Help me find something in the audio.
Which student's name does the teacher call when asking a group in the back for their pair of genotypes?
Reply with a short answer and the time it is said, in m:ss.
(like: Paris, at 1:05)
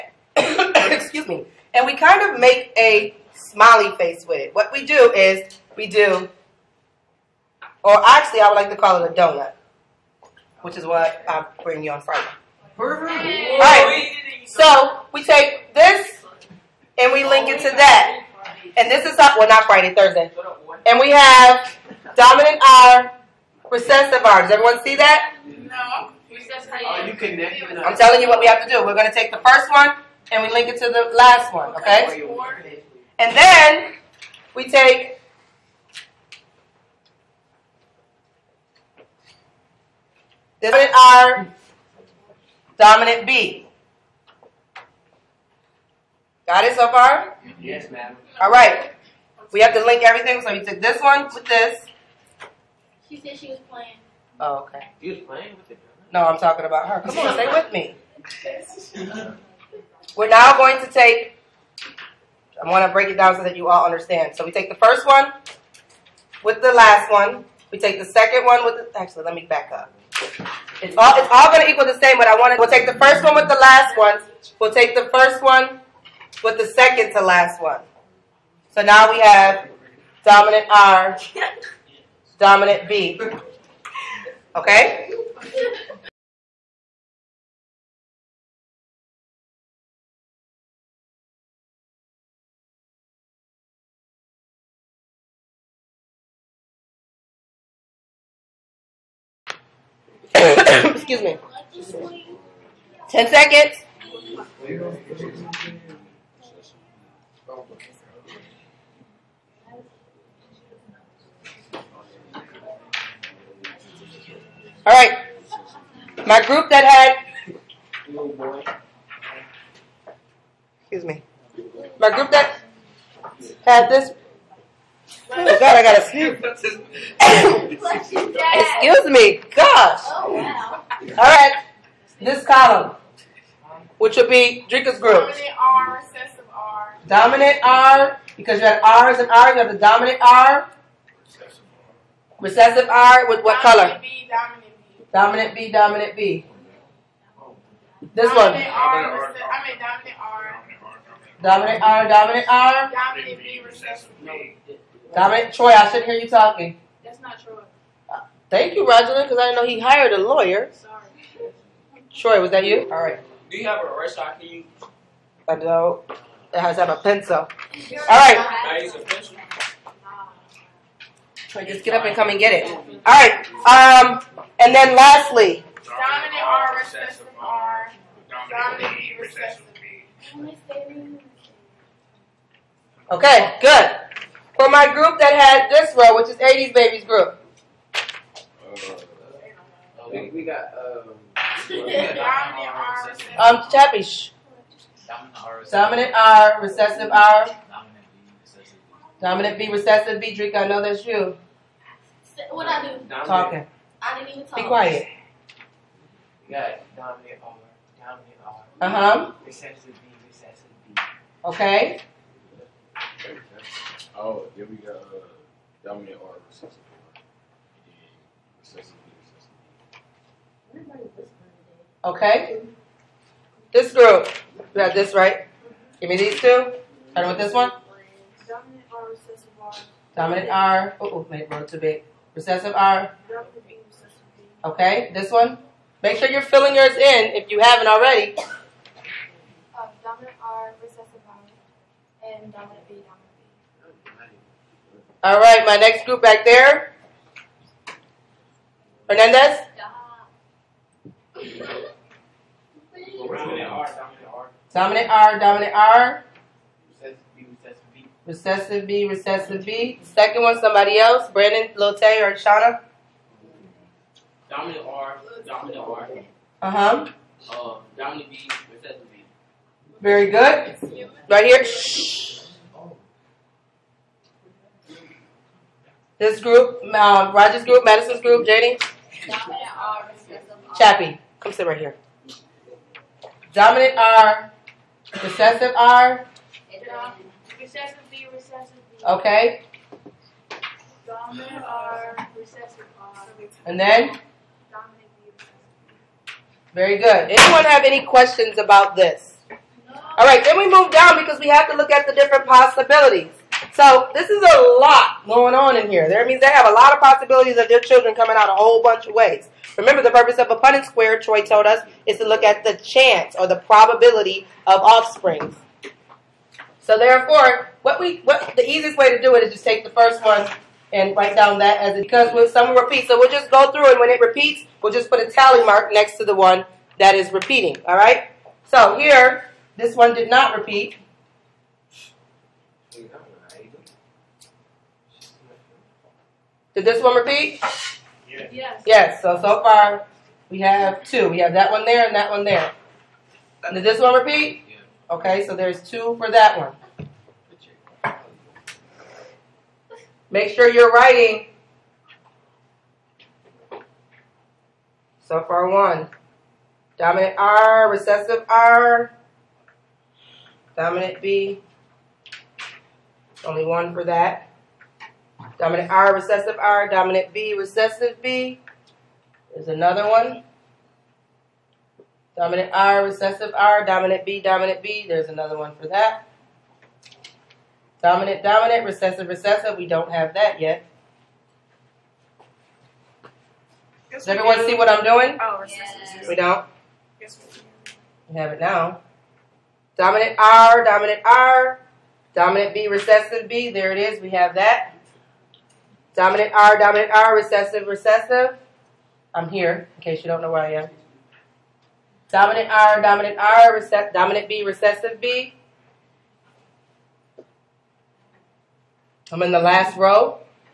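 Hernandez, at 4:09.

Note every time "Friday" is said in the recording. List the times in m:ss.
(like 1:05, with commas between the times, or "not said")
0:12, 0:19.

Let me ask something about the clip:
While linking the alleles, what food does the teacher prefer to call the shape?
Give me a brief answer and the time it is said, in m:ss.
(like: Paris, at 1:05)
Donut, at 0:09.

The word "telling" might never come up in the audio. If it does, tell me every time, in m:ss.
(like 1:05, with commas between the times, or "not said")
0:27.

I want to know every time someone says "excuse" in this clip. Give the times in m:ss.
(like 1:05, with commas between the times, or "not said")
0:01, 1:41, 2:00, 2:08.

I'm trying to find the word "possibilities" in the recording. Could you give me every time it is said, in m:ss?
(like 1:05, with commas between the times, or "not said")
5:02, 5:06.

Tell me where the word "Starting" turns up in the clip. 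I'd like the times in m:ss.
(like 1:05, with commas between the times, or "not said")
3:47.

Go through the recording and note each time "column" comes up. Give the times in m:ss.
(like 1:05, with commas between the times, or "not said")
2:12.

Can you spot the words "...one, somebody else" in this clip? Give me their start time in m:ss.
4:20.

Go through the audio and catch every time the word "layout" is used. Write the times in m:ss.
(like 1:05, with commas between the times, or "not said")
not said.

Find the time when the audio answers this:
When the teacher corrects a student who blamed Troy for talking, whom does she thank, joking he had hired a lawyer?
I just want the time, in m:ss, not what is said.
2:38.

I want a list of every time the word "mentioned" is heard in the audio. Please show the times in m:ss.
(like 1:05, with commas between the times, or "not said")
not said.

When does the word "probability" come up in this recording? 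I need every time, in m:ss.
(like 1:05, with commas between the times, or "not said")
5:13.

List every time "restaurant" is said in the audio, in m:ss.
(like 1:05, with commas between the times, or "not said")
2:43.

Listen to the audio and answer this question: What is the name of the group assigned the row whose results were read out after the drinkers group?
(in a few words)
80s Babies group.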